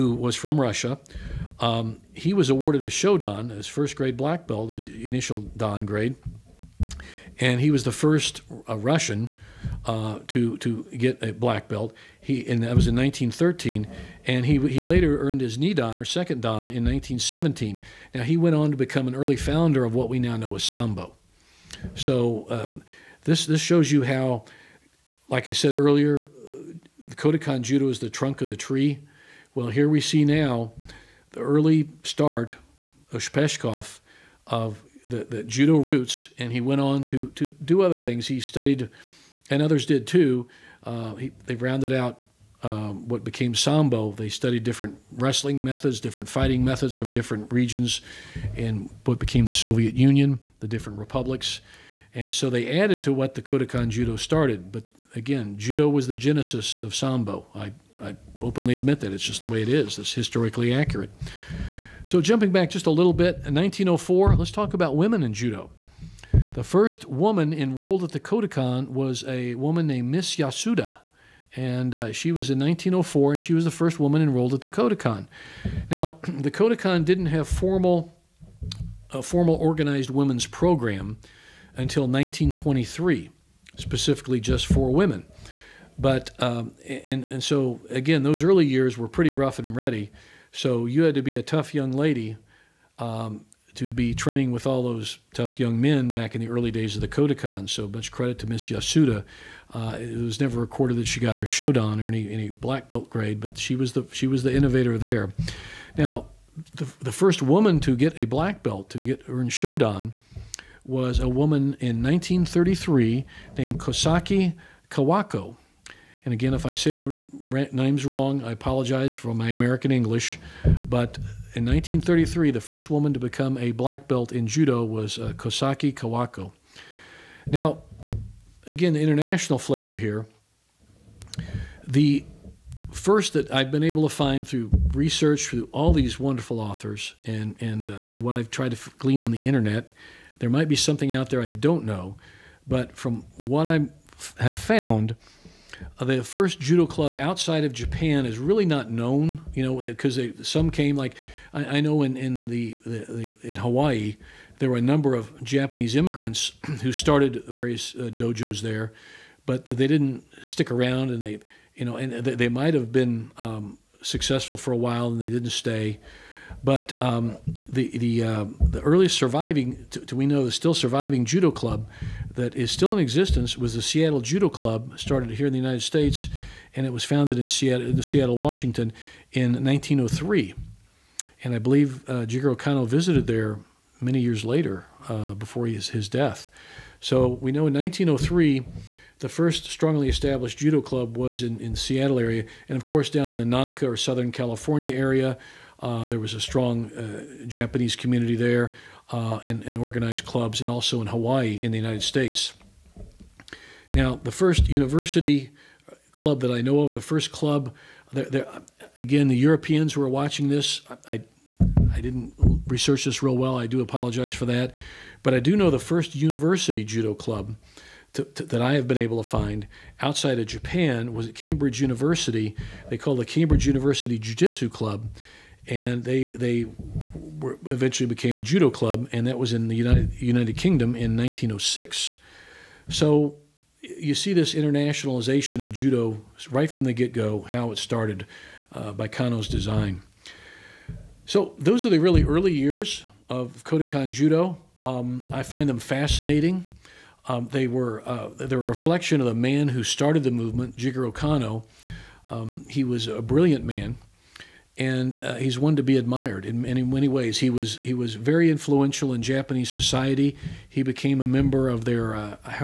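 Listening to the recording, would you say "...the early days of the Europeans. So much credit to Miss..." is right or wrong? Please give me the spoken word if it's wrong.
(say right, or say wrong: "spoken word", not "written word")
wrong: "Kodokan", not "Europeans".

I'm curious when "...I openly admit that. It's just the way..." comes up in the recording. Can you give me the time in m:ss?
0:57.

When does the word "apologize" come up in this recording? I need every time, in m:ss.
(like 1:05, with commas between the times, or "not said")
1:58, 3:33.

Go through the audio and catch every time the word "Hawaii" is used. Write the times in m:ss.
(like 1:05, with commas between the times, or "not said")
2:33, 3:21.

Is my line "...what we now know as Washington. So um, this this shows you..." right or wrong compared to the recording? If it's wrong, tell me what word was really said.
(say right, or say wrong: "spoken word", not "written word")
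wrong: "Sambo", not "Washington".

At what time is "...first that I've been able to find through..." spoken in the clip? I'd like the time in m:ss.
2:12.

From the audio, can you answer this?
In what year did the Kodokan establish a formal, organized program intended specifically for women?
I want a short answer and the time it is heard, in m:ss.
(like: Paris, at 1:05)
1923, at 1:22.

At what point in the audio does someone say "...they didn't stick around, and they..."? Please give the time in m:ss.
2:39.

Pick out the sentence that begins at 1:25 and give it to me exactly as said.
But um, and and so again, those early years were pretty rough and ready.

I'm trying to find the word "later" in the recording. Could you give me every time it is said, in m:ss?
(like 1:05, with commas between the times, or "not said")
0:14, 3:04.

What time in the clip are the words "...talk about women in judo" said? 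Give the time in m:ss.
1:04.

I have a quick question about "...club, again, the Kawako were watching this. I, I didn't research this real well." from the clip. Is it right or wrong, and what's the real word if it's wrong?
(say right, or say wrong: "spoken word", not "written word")
wrong: "Europeans", not "Kawako".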